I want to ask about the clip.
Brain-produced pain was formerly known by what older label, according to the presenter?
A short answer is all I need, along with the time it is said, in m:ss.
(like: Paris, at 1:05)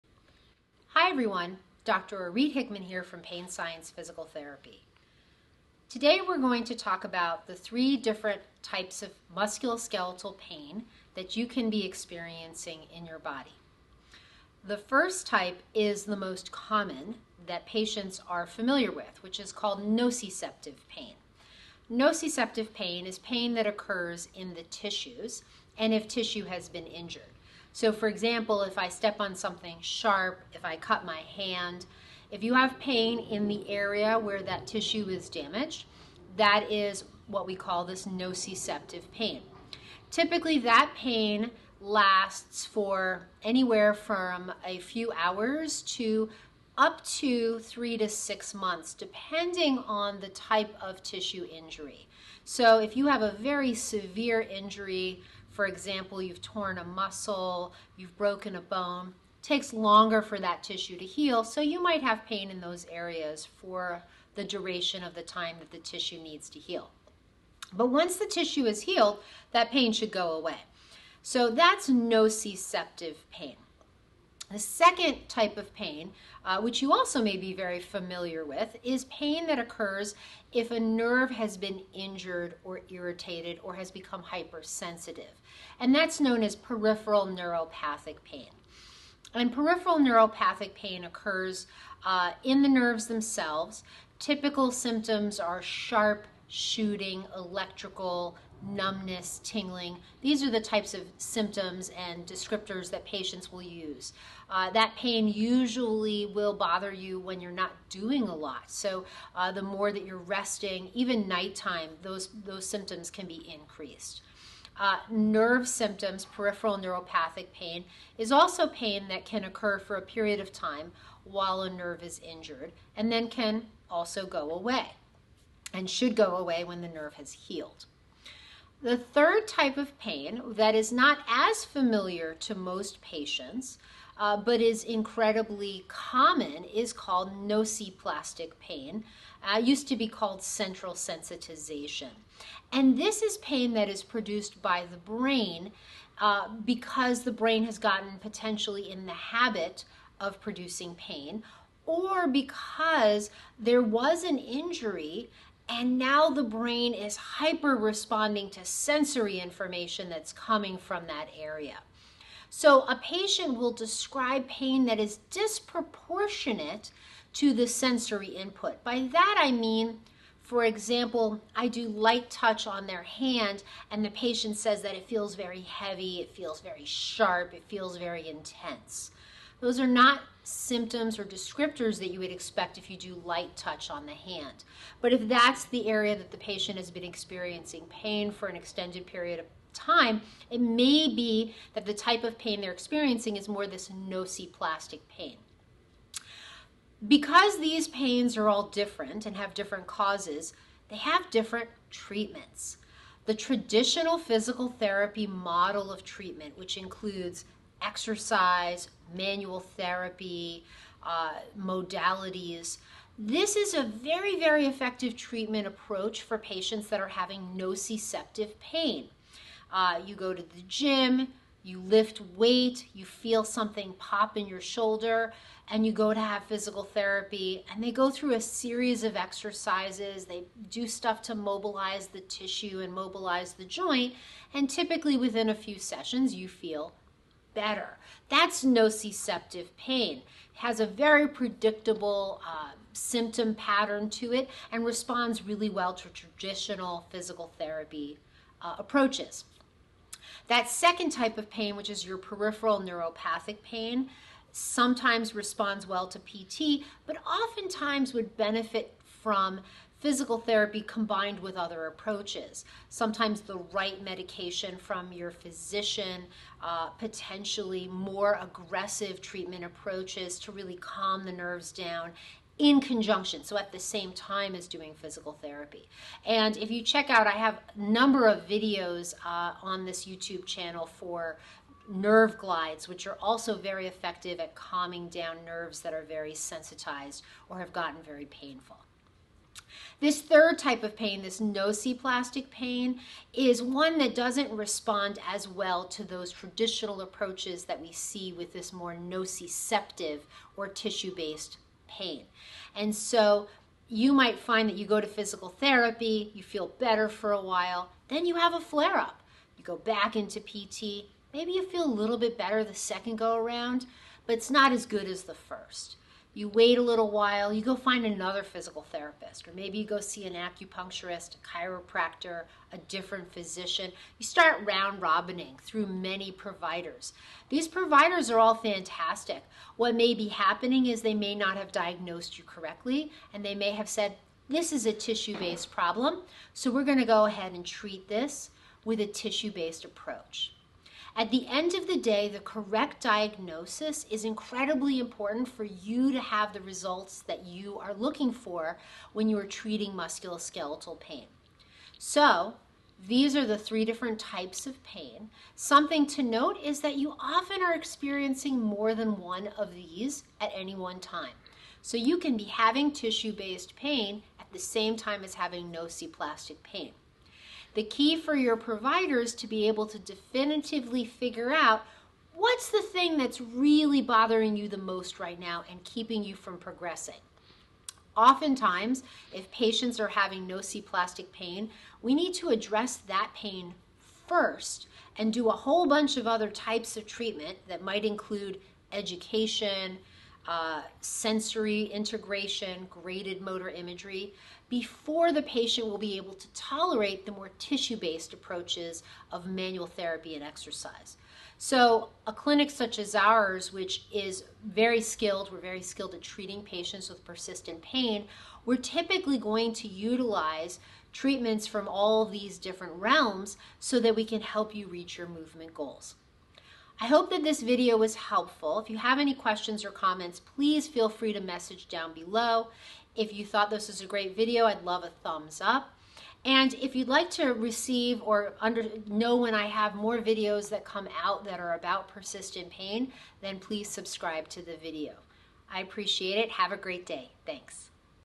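central sensitization, at 2:20.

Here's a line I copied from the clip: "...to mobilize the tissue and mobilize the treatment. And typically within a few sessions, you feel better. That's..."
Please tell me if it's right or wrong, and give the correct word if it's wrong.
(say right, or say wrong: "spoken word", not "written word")
wrong: "joint", not "treatment".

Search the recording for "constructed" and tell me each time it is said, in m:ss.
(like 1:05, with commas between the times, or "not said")
not said.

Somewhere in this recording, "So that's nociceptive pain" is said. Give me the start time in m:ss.
1:11.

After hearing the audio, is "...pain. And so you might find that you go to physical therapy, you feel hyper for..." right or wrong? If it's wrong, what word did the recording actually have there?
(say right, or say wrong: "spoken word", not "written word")
wrong: "better", not "hyper".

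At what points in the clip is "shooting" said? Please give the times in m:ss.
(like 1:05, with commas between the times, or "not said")
1:36.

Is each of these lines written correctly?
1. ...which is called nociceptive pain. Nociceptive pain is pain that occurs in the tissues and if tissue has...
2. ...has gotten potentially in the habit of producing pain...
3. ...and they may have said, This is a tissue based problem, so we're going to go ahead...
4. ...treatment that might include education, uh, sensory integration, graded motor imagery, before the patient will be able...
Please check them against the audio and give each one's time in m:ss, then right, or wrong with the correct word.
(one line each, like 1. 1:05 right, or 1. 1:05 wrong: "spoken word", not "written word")
1. 0:19 right
2. 2:27 right
3. 5:33 right
4. 6:27 right.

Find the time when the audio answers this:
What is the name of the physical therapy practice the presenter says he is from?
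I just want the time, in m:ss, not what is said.
0:03.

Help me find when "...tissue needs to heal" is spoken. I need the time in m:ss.
1:05.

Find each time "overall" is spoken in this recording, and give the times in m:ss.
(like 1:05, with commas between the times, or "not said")
not said.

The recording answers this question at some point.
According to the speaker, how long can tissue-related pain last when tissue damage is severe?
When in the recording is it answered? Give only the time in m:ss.
0:47.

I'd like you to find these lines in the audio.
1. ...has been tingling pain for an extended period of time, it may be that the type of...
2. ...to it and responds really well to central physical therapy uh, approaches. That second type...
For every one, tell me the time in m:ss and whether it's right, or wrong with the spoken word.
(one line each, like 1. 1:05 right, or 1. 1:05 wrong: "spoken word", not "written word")
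1. 3:06 wrong: "experiencing", not "tingling"
2. 4:04 wrong: "traditional", not "central".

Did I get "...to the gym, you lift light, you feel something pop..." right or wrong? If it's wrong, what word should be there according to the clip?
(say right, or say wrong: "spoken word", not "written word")
wrong: "weight", not "light".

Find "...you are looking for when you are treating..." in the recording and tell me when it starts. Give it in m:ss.
5:47.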